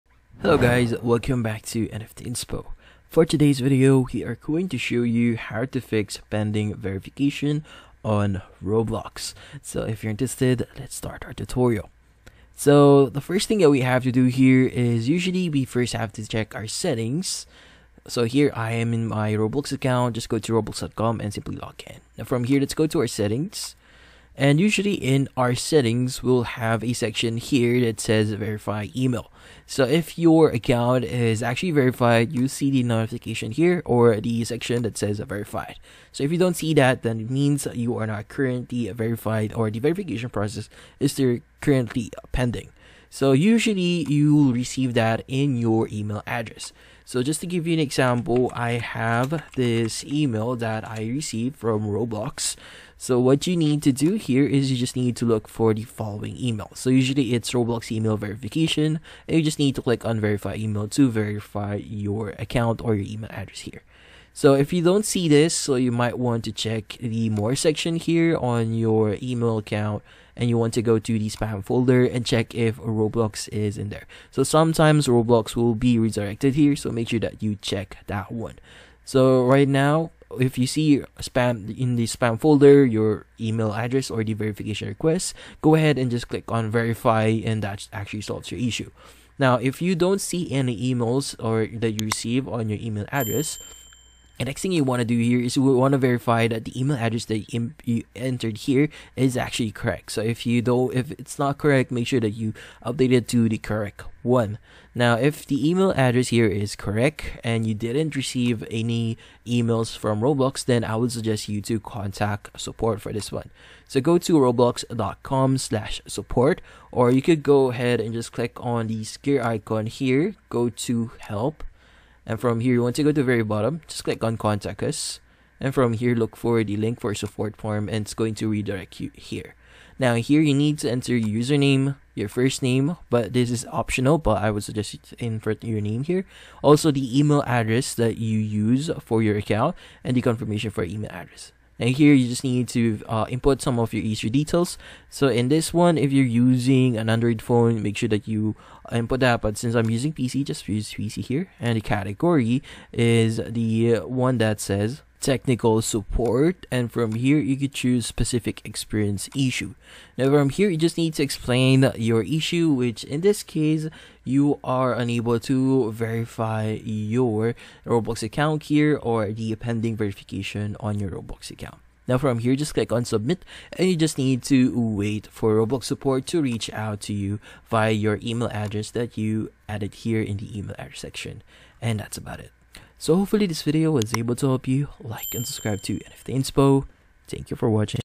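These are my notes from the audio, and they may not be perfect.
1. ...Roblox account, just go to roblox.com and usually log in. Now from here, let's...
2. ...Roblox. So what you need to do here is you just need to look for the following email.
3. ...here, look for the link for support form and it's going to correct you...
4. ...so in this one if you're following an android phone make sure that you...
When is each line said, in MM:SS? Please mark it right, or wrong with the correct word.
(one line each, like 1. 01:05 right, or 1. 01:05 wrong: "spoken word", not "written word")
1. 00:19 wrong: "simply", not "usually"
2. 00:51 right
3. 02:05 wrong: "redirect", not "correct"
4. 02:25 wrong: "using", not "following".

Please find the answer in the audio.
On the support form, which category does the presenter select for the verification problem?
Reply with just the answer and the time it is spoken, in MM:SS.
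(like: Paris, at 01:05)
Technical support, at 02:35.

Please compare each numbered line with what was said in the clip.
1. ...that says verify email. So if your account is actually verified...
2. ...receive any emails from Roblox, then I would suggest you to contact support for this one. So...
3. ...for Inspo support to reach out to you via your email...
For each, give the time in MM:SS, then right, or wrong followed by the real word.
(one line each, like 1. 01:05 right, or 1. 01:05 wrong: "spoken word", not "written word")
1. 00:27 right
2. 01:48 right
3. 02:55 wrong: "Roblox", not "Inspo".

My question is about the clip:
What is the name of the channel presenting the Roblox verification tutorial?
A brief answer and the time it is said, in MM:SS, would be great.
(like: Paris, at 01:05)
NFT Inspo, at 00:01.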